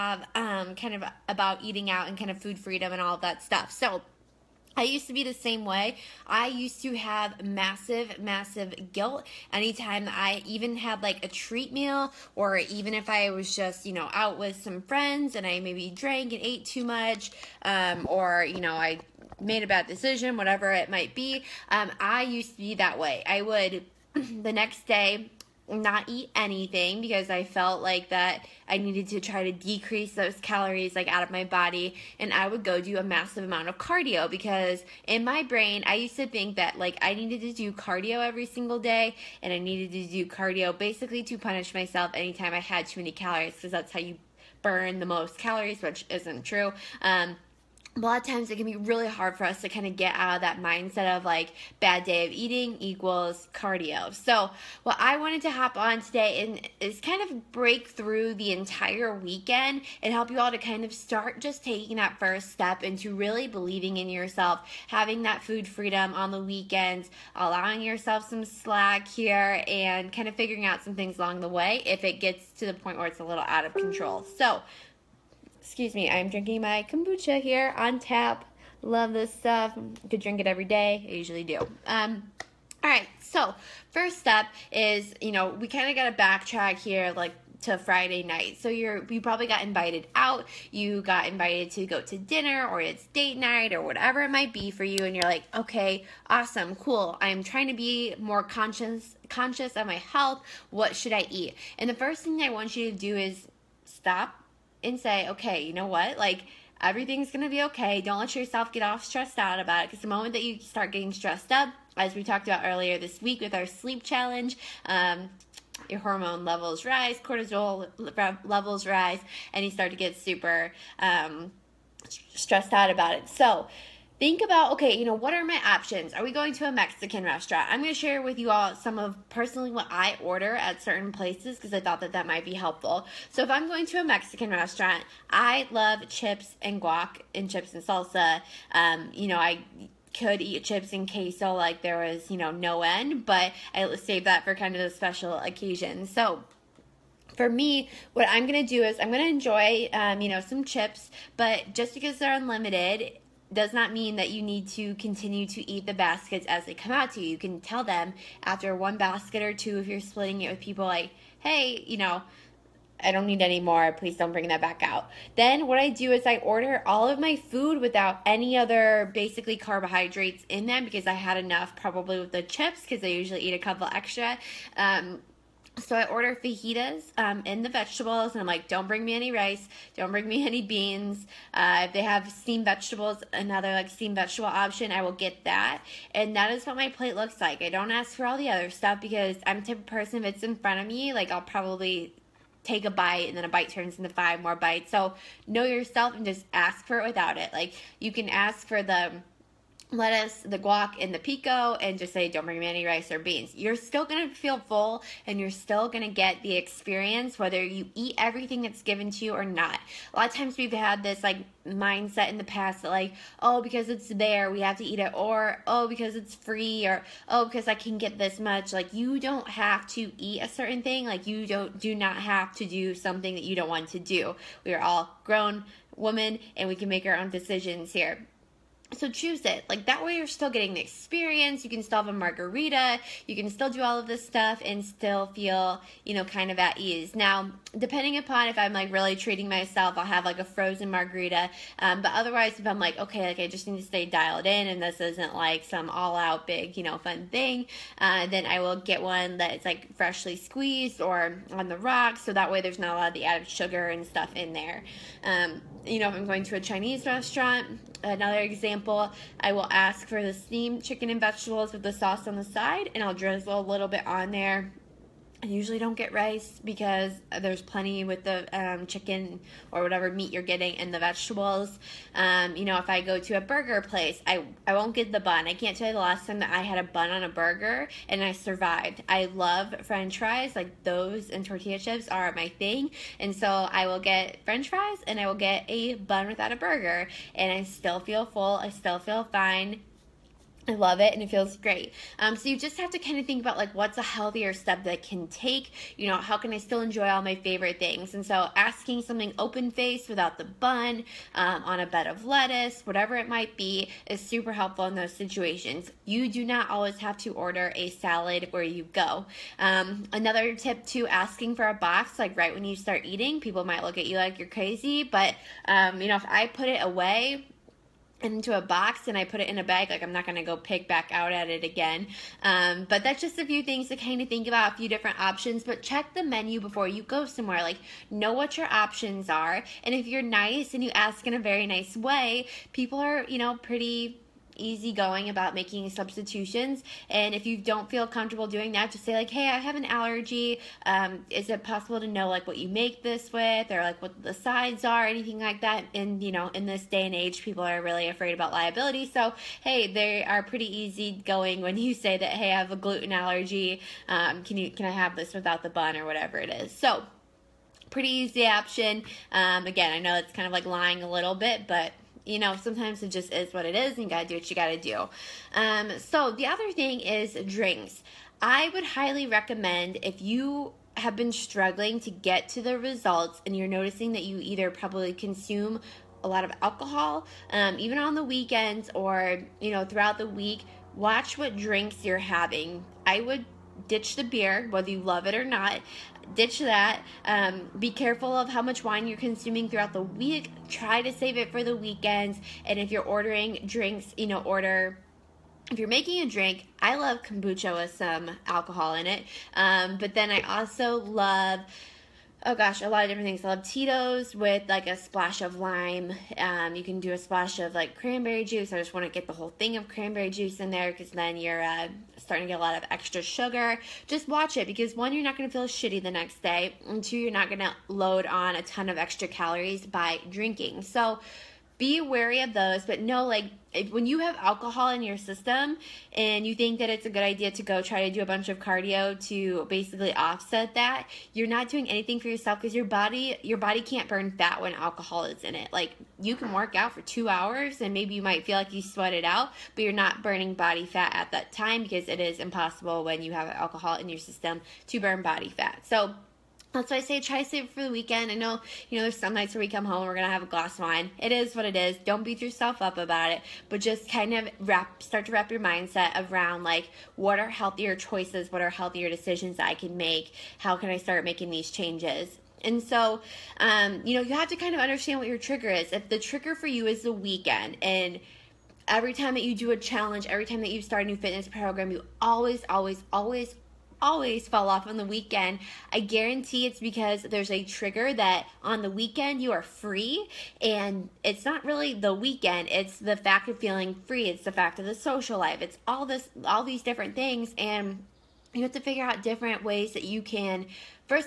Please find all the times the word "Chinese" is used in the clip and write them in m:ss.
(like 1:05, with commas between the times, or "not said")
4:16.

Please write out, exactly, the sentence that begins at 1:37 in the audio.
I'm trying to be more conscious conscious of my health.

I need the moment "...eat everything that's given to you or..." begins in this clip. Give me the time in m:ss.
3:27.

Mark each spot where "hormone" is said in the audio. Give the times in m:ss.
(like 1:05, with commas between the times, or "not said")
1:55.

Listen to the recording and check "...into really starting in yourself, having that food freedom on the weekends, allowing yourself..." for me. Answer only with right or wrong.
wrong.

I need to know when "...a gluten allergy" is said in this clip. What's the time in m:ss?
5:52.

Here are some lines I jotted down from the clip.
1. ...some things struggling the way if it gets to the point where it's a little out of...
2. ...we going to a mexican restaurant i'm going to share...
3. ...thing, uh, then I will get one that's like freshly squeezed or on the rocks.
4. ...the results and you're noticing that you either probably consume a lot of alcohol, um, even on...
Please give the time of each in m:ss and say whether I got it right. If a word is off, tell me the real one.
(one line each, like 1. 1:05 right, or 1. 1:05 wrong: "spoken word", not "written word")
1. 1:10 wrong: "along", not "struggling"
2. 2:06 right
3. 4:07 right
4. 6:12 right.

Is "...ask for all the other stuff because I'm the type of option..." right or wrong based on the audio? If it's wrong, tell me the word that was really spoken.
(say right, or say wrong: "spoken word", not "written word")
wrong: "person", not "option".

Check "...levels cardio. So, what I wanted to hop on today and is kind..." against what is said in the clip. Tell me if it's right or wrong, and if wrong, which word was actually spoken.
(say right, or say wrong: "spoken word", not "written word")
wrong: "equals", not "levels".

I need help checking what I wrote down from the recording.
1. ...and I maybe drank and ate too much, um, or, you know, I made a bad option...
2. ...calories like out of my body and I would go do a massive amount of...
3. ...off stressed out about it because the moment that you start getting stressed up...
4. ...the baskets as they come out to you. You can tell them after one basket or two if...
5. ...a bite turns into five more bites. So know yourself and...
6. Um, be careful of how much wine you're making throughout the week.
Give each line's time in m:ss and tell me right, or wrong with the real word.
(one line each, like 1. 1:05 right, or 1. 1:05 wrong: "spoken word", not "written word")
1. 0:15 wrong: "decision", not "option"
2. 0:30 right
3. 1:48 right
4. 2:35 right
5. 3:13 right
6. 6:27 wrong: "consuming", not "making".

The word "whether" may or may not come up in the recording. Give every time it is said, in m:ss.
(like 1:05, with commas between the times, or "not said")
3:27, 6:24.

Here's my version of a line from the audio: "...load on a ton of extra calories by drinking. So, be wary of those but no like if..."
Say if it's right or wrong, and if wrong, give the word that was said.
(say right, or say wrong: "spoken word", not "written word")
right.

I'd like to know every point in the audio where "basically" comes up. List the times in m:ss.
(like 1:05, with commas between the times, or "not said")
0:40, 2:49, 7:09.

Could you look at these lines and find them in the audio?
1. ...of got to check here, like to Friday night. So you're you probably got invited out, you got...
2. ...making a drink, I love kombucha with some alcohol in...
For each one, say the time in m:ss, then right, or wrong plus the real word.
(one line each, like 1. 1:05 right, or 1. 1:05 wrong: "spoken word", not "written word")
1. 1:25 wrong: "backtrack", not "check"
2. 6:35 right.